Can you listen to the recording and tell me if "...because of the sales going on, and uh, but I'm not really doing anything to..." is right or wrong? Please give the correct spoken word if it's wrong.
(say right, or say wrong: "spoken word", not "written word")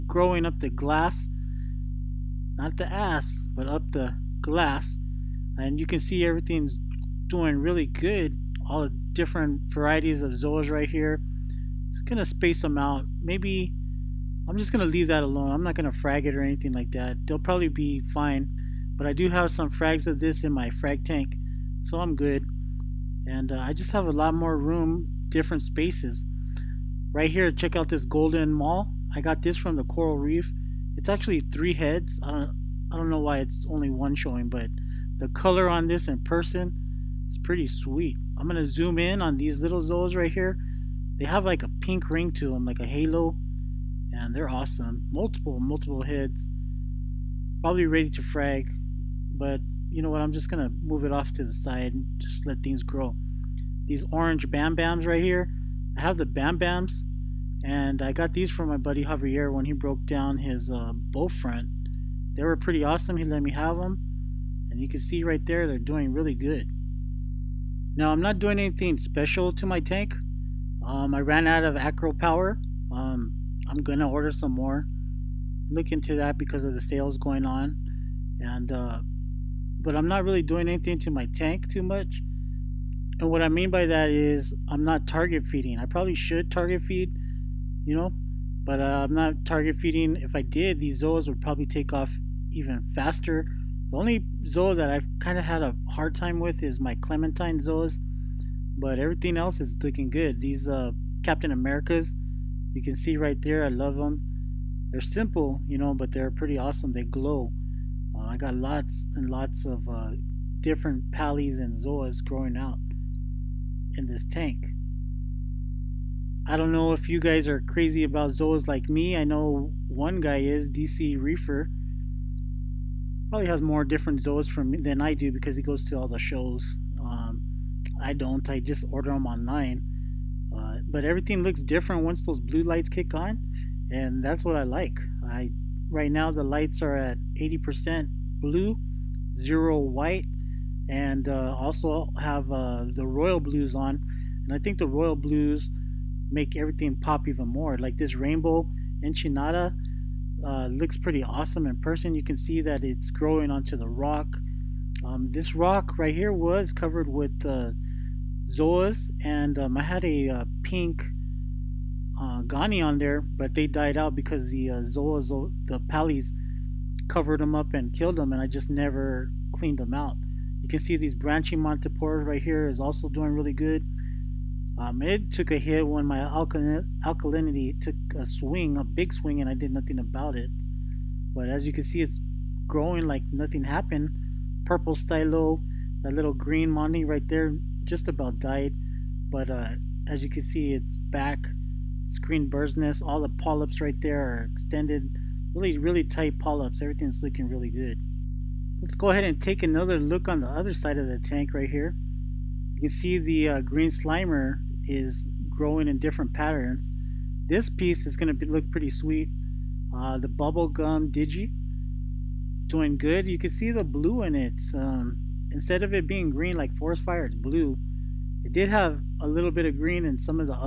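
right.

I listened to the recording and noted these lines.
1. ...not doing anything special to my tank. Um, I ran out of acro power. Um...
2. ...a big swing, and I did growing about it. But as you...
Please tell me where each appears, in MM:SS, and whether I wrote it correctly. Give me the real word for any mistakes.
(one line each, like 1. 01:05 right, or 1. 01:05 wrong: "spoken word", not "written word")
1. 01:08 right
2. 02:58 wrong: "nothing", not "growing".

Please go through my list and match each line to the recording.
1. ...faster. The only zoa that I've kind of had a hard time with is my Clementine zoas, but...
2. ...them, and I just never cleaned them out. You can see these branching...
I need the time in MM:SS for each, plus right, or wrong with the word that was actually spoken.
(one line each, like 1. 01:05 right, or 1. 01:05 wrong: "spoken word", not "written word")
1. 01:32 right
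2. 02:48 right.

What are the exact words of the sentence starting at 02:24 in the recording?
And I think the royal blues make everything pop even more.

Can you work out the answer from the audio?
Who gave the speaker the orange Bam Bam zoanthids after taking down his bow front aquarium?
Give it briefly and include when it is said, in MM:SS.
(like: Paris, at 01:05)
Javier, at 00:59.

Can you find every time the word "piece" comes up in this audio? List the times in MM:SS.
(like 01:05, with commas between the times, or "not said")
03:27.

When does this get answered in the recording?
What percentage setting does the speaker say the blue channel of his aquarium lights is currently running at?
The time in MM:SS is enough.
02:17.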